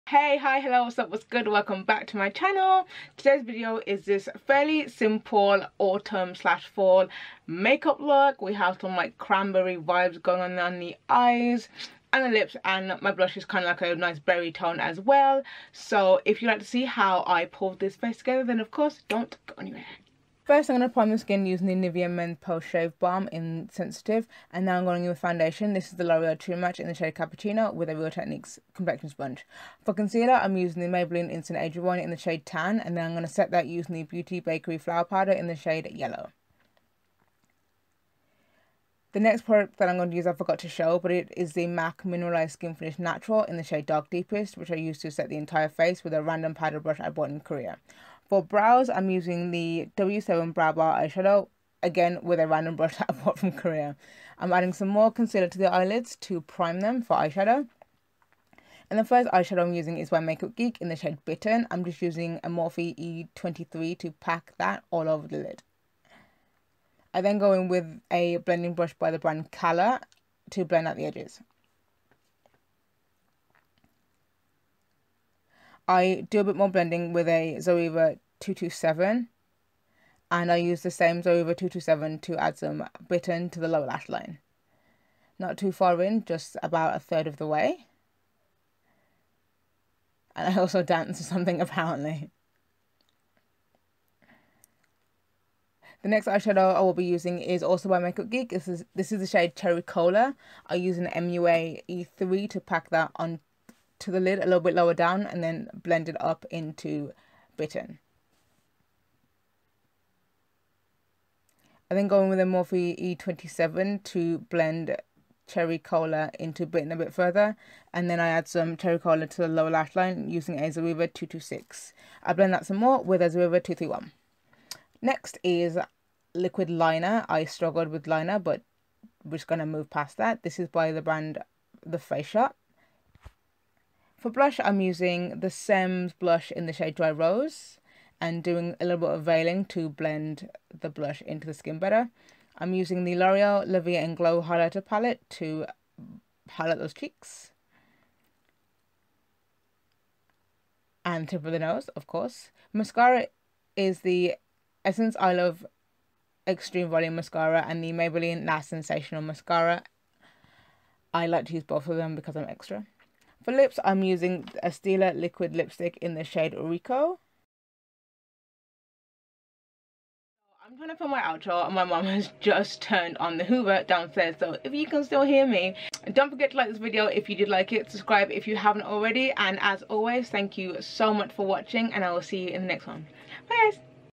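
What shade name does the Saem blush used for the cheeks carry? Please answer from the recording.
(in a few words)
Dry Rose.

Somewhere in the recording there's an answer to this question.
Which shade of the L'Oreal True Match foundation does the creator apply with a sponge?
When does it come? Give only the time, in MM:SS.
00:27.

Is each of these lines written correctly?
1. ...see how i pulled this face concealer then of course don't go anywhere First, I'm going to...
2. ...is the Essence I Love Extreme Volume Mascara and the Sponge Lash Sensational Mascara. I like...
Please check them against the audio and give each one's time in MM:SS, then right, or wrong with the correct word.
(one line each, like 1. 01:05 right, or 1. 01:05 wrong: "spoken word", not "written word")
1. 00:16 wrong: "together", not "concealer"
2. 02:33 wrong: "Maybelline", not "Sponge".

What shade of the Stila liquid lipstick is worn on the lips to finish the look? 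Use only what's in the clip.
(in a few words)
Ricco.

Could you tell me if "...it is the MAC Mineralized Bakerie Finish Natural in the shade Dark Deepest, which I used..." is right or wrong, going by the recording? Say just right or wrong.
wrong.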